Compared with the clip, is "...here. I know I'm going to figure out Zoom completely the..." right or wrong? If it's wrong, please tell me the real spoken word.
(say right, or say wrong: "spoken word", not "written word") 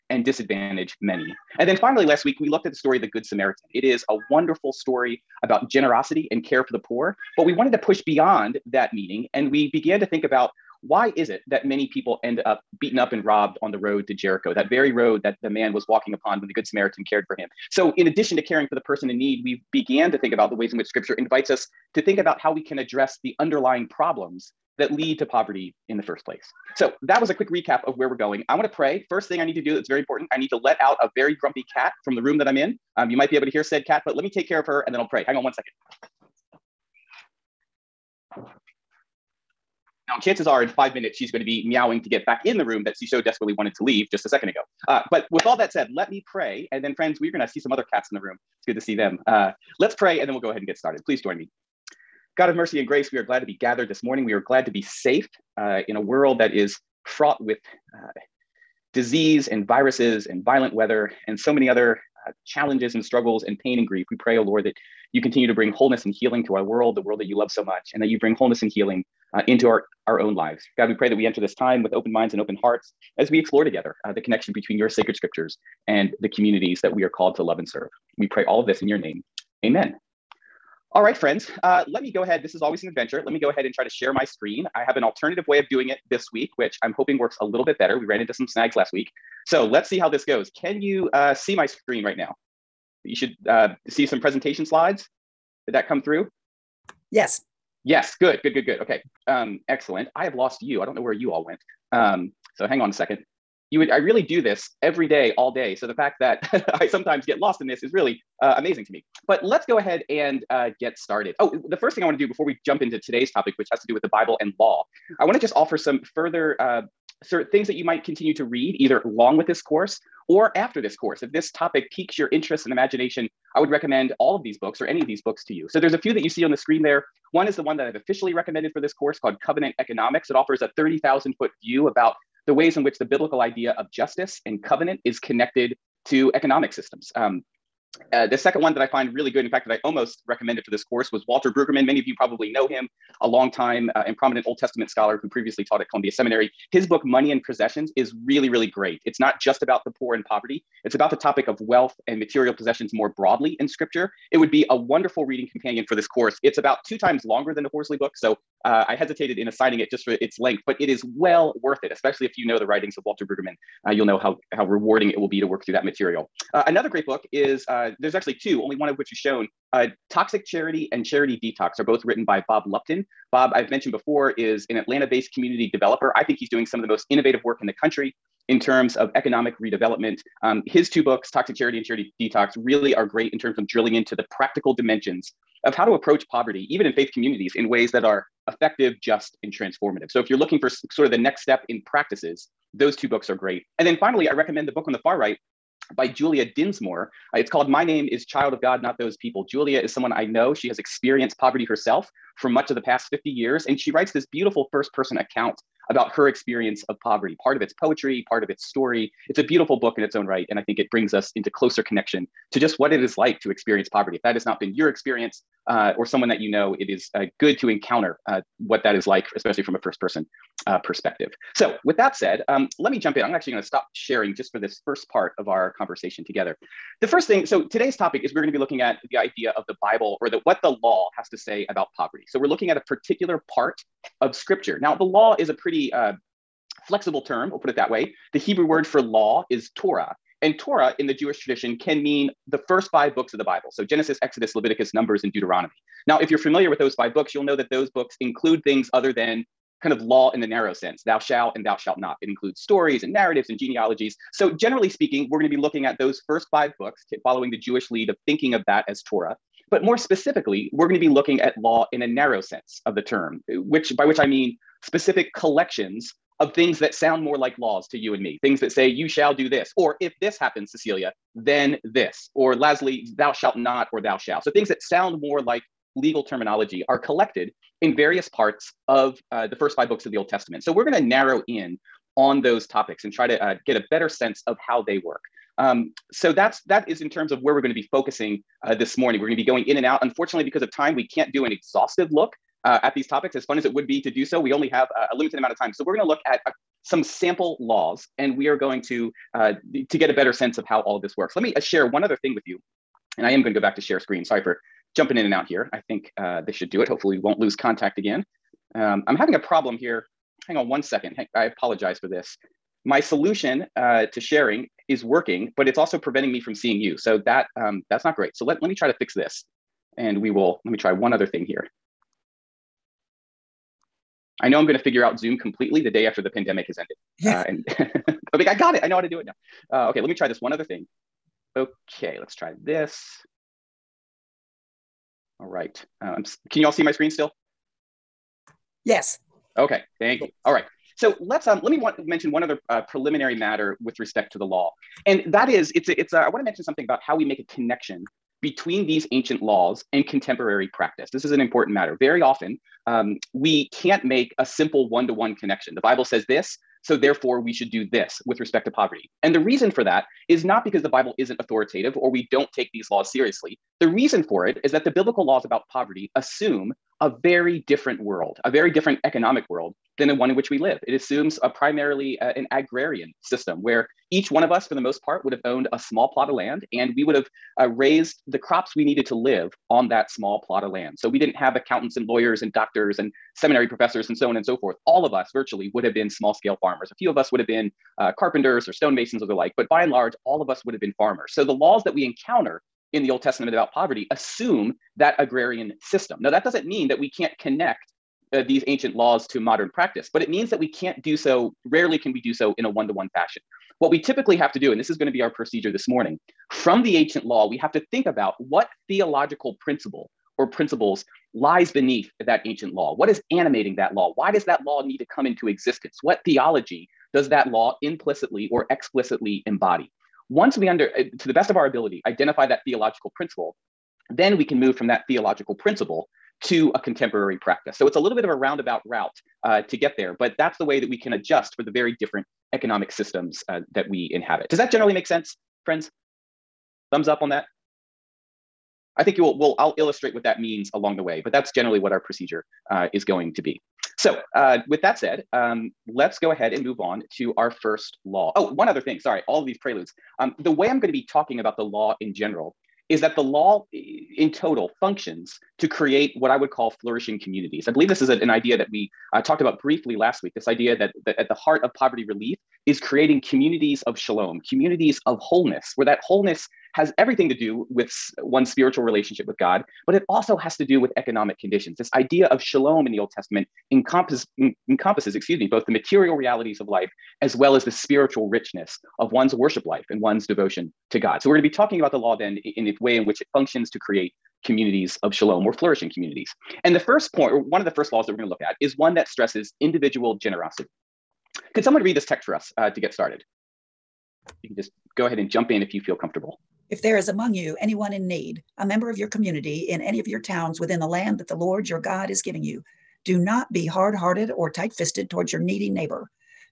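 right.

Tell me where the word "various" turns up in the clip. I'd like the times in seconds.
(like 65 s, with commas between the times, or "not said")
277 s.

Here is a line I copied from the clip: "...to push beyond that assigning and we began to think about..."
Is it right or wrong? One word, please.
wrong.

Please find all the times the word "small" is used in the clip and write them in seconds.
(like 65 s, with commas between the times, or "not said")
375 s, 380 s, 386 s.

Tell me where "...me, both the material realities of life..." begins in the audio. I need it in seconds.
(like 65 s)
475 s.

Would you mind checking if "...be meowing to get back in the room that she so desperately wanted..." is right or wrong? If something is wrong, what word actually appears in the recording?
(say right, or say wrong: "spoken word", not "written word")
right.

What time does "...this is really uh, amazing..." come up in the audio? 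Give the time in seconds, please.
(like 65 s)
107 s.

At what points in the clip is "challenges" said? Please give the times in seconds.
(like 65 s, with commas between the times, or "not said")
62 s.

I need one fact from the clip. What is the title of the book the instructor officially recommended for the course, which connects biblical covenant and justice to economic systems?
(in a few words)
Covenant Economics.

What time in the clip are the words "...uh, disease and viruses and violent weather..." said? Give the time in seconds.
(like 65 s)
57 s.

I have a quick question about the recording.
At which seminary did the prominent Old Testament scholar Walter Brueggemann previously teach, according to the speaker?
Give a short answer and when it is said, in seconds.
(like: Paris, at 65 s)
Columbia Seminary, at 145 s.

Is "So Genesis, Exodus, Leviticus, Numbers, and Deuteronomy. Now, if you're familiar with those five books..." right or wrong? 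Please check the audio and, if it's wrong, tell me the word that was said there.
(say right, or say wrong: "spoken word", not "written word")
right.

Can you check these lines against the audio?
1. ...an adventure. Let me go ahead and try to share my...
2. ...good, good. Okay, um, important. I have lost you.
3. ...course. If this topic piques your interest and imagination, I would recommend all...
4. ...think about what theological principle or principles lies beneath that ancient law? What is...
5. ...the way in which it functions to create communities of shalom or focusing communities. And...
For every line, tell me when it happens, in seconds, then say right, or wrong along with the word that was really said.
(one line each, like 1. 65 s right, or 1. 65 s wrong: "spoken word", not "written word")
1. 82 s right
2. 98 s wrong: "excellent", not "important"
3. 120 s right
4. 407 s right
5. 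482 s wrong: "flourishing", not "focusing".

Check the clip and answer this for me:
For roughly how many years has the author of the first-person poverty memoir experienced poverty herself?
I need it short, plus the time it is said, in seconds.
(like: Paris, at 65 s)
50 years, at 203 s.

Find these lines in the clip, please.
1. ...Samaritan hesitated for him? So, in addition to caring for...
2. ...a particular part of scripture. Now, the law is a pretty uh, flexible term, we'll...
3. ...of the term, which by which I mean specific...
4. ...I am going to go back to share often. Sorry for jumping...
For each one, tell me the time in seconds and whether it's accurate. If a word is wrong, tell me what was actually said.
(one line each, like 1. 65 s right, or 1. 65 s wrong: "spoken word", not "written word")
1. 16 s wrong: "cared", not "hesitated"
2. 232 s right
3. 262 s right
4. 303 s wrong: "screen", not "often".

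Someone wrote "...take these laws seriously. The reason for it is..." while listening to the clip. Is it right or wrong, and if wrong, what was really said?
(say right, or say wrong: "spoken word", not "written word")
right.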